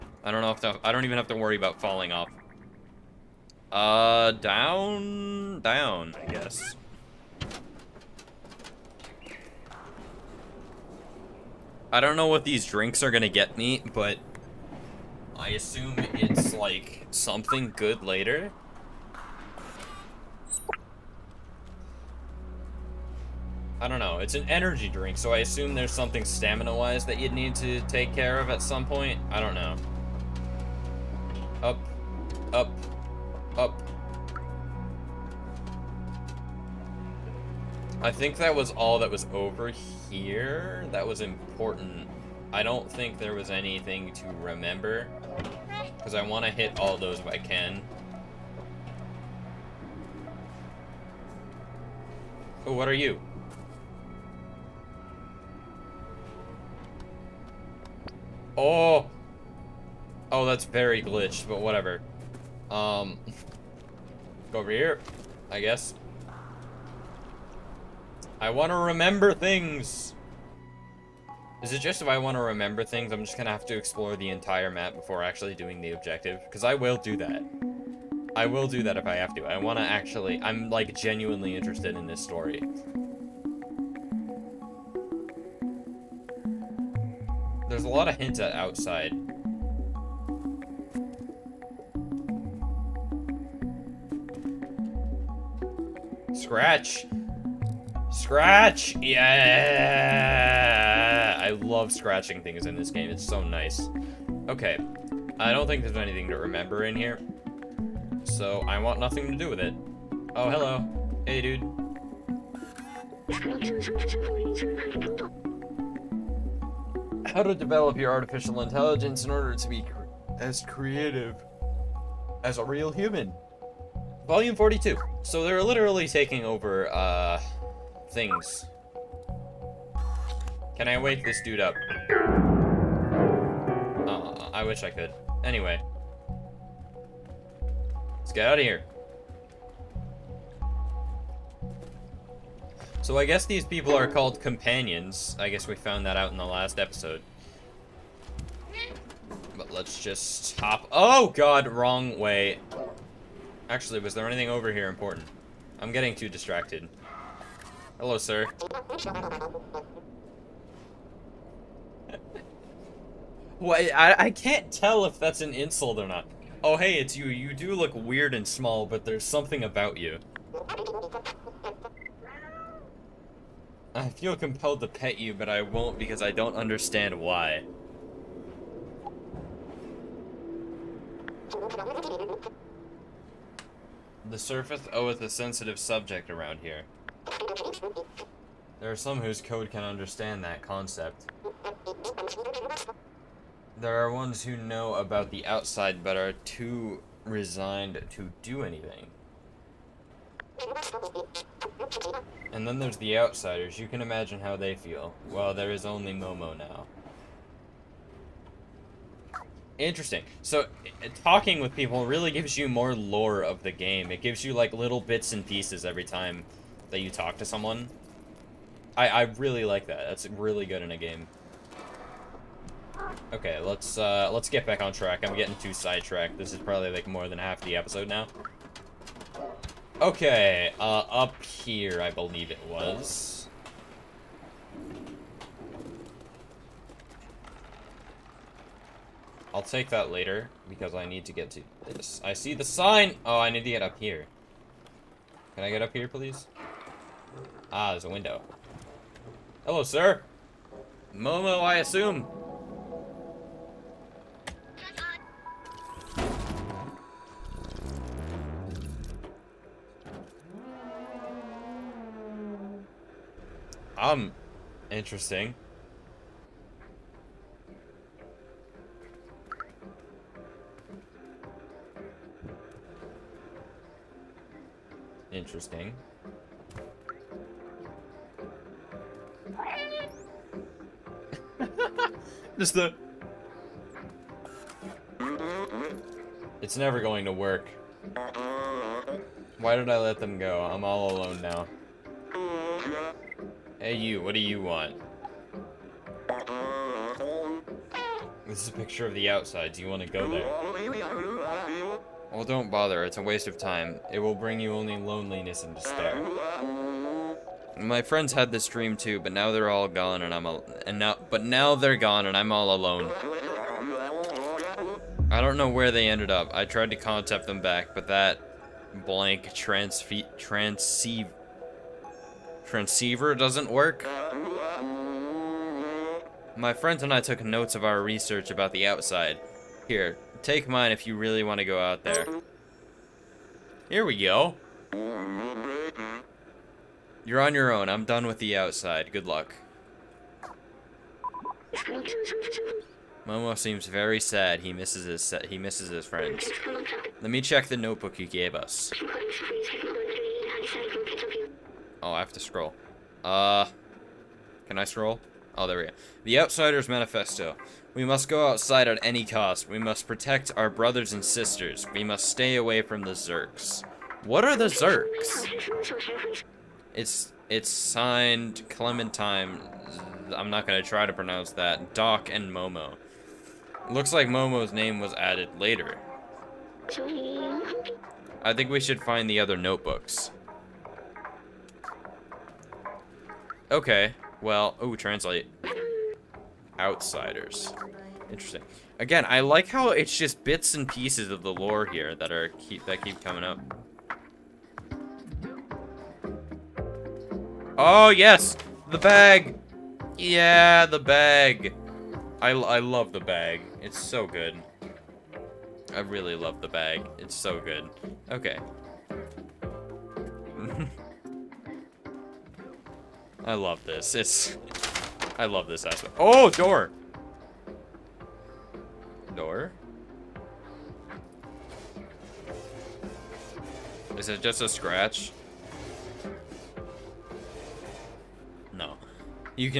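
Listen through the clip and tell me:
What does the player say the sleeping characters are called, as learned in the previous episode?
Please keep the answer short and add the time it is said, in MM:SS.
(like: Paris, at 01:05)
Companions, at 02:24.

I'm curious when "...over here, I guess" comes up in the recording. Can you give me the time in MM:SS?
01:04.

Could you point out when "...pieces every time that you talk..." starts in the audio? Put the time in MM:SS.
03:35.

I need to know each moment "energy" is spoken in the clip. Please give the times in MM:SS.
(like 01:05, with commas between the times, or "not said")
00:24.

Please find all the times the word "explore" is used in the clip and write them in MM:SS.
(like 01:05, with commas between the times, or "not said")
01:13.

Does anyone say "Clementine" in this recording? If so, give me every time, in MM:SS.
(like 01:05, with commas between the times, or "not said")
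06:08.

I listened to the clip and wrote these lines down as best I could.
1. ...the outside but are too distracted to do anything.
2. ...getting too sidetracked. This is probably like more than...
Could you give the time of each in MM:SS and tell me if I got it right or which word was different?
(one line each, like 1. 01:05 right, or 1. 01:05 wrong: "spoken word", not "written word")
1. 03:15 wrong: "resigned", not "distracted"
2. 03:45 right.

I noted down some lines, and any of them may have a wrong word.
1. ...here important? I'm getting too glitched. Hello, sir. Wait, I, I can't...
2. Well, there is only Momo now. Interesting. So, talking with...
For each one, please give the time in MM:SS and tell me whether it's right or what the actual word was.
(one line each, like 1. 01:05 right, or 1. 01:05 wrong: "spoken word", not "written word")
1. 02:34 wrong: "distracted", not "glitched"
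2. 03:25 right.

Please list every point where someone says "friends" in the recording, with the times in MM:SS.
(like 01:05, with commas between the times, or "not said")
05:08, 05:26, 05:46.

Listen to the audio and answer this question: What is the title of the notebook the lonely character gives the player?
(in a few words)
The Outsider's Manifesto.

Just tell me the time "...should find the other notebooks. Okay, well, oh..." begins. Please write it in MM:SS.
06:18.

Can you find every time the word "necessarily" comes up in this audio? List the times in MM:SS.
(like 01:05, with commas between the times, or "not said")
not said.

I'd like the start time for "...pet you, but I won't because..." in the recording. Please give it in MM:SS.
02:54.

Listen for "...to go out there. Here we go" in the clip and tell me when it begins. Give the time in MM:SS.
05:31.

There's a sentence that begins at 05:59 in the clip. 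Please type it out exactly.
We must protect our brothers and sisters.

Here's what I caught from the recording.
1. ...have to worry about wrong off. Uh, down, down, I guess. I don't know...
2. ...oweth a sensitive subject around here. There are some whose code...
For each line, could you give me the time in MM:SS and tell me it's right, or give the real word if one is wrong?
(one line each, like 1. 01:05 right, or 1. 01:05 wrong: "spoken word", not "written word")
1. 00:01 wrong: "falling", not "wrong"
2. 03:04 right.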